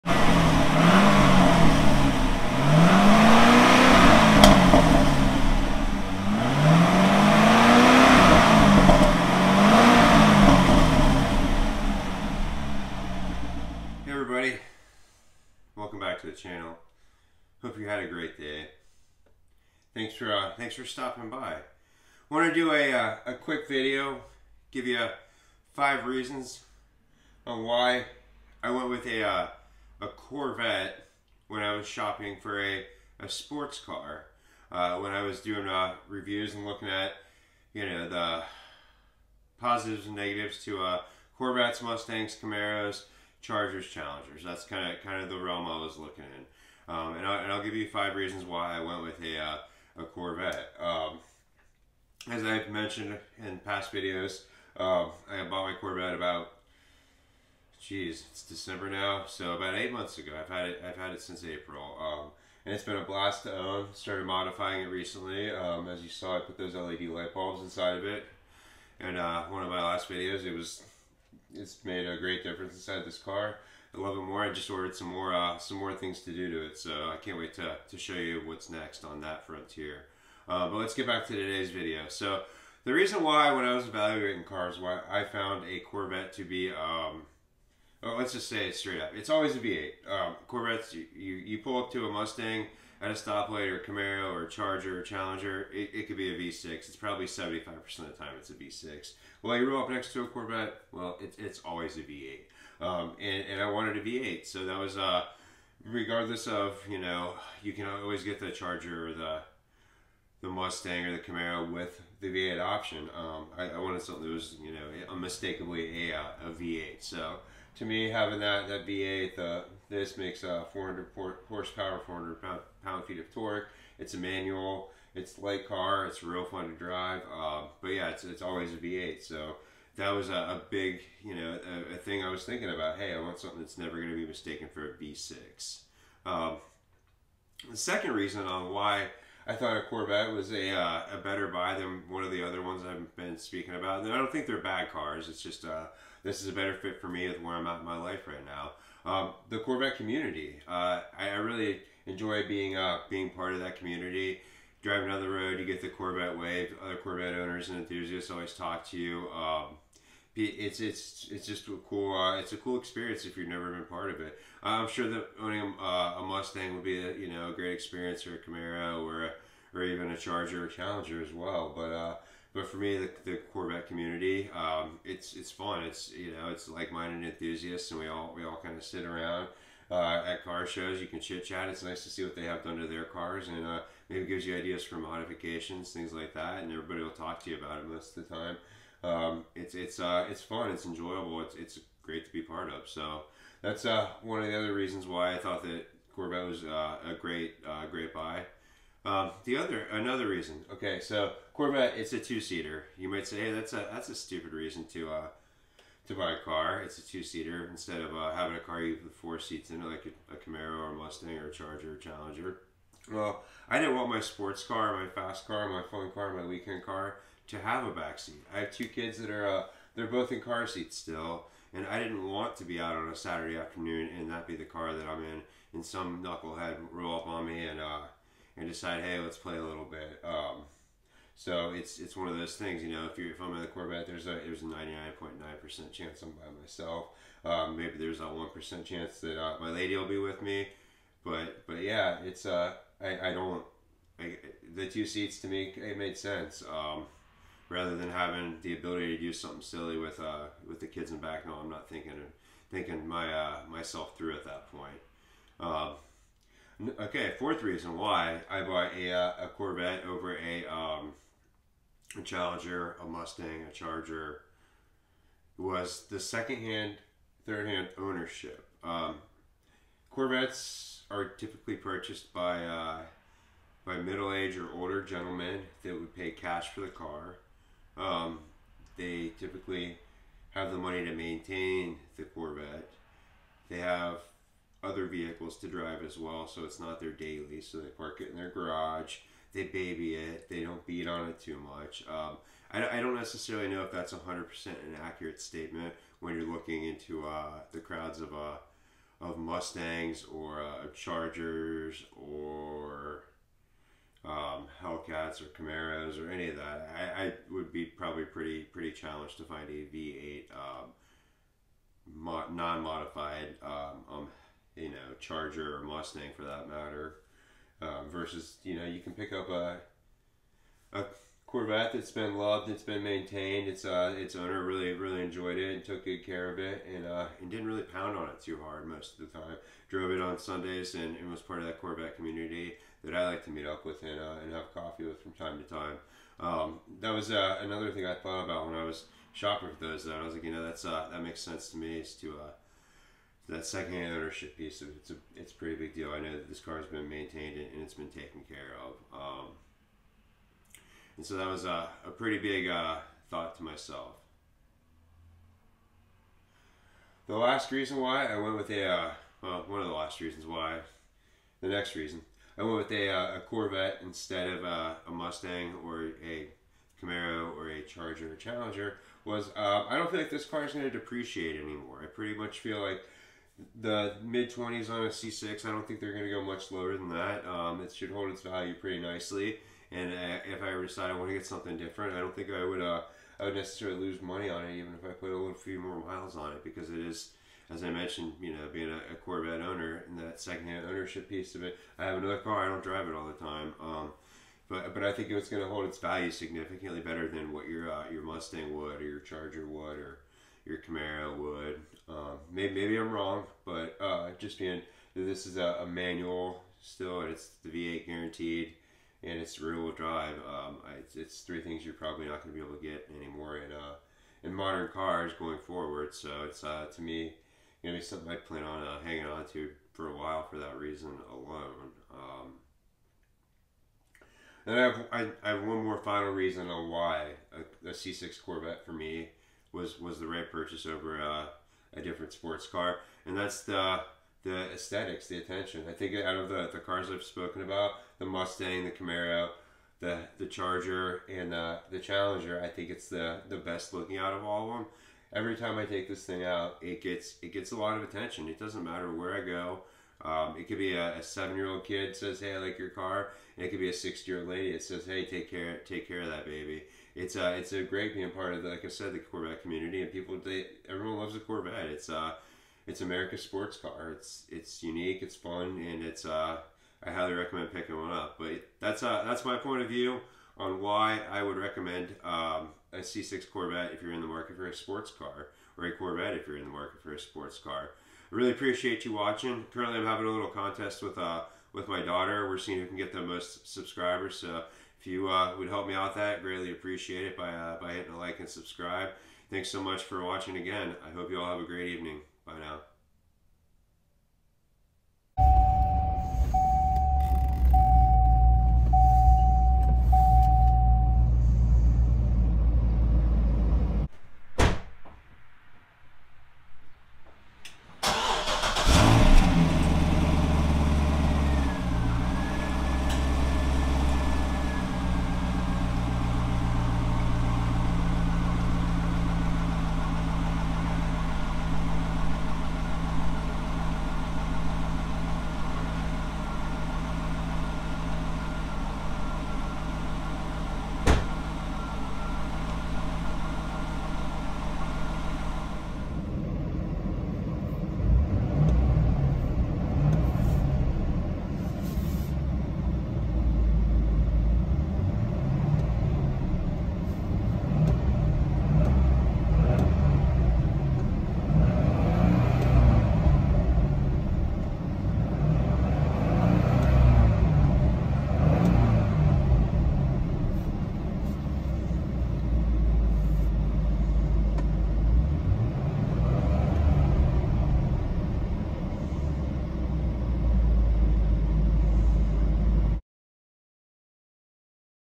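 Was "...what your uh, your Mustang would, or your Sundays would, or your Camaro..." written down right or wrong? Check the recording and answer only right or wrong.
wrong.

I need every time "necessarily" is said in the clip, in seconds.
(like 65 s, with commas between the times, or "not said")
293 s, 383 s.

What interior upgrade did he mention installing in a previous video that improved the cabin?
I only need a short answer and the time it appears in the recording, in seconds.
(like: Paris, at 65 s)
LED light bulbs, at 66 s.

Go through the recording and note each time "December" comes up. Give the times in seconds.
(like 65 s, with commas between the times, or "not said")
58 s.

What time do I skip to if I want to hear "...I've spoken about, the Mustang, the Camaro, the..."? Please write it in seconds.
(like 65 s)
437 s.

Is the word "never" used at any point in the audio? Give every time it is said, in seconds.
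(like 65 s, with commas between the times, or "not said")
133 s, 163 s.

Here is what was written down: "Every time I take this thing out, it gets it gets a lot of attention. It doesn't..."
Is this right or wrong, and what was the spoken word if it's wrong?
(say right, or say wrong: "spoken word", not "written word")
right.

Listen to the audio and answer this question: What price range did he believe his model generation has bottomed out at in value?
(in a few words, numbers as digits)
Mid 20s.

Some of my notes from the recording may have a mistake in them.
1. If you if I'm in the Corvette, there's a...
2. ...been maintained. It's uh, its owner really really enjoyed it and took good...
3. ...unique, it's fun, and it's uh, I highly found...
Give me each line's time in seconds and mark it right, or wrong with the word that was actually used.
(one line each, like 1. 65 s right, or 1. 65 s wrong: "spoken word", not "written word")
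1. 233 s right
2. 322 s right
3. 464 s wrong: "recommend", not "found".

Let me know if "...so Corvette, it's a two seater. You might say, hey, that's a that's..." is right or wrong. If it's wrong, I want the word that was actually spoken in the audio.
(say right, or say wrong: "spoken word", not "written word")
right.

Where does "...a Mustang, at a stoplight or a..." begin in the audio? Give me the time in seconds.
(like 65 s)
92 s.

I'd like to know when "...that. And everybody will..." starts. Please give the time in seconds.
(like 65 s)
186 s.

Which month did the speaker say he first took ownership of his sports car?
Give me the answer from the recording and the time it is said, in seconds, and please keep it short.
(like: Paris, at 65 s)
April, at 61 s.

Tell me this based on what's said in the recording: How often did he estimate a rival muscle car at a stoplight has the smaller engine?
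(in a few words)
75%.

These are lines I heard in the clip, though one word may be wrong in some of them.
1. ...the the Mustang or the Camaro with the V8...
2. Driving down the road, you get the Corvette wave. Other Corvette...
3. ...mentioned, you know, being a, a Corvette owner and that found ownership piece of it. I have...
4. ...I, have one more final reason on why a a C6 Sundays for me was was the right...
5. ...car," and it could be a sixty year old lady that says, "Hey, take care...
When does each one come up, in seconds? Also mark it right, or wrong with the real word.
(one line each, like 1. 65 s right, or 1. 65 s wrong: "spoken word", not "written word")
1. 109 s right
2. 154 s right
3. 387 s wrong: "secondhand", not "found"
4. 425 s wrong: "Corvette", not "Sundays"
5. 452 s right.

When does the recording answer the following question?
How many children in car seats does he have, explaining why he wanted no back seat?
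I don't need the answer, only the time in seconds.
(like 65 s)
218 s.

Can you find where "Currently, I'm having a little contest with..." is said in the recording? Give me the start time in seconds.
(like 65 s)
479 s.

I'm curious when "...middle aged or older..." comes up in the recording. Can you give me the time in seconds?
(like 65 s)
273 s.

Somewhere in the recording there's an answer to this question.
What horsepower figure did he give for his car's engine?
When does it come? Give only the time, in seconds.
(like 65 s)
120 s.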